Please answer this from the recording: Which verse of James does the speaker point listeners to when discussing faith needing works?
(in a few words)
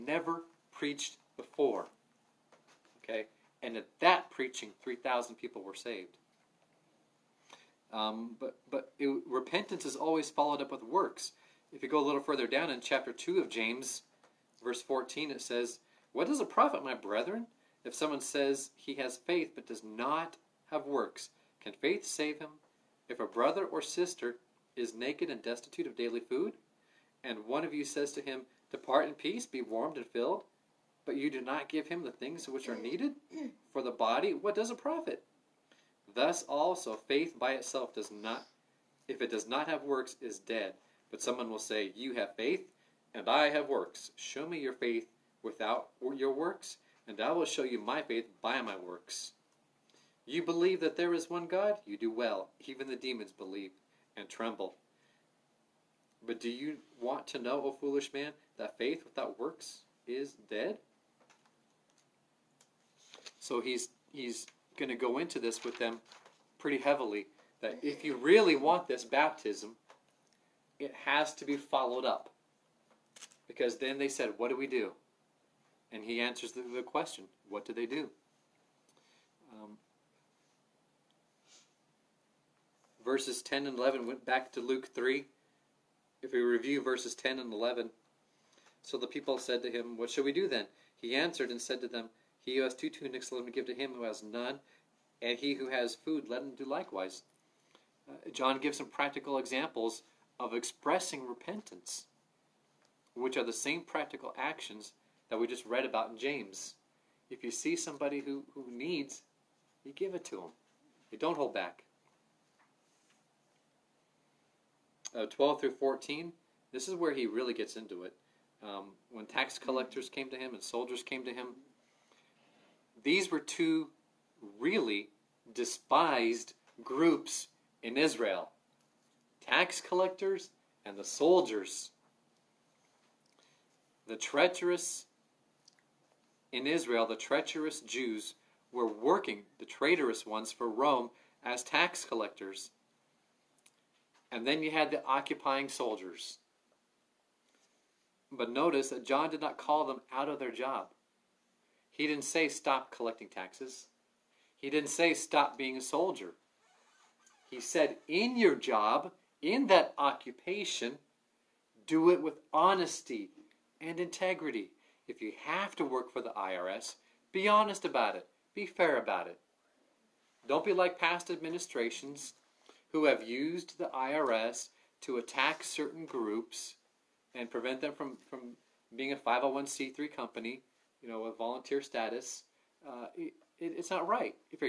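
Verse 14.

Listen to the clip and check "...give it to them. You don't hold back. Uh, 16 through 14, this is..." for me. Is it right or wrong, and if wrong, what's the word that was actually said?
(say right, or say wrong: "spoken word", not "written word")
wrong: "12", not "16".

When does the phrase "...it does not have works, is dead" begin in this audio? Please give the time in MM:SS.
00:39.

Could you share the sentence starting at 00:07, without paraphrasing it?
Um, but but it, repentance is always followed up with works.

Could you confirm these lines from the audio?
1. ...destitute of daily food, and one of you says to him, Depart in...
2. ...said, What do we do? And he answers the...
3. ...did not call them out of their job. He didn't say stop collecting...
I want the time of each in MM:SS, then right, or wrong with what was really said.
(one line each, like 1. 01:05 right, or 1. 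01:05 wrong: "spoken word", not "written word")
1. 00:25 right
2. 01:14 right
3. 02:29 right.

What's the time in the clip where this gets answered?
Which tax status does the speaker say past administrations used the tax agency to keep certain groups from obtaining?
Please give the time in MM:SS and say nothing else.
02:59.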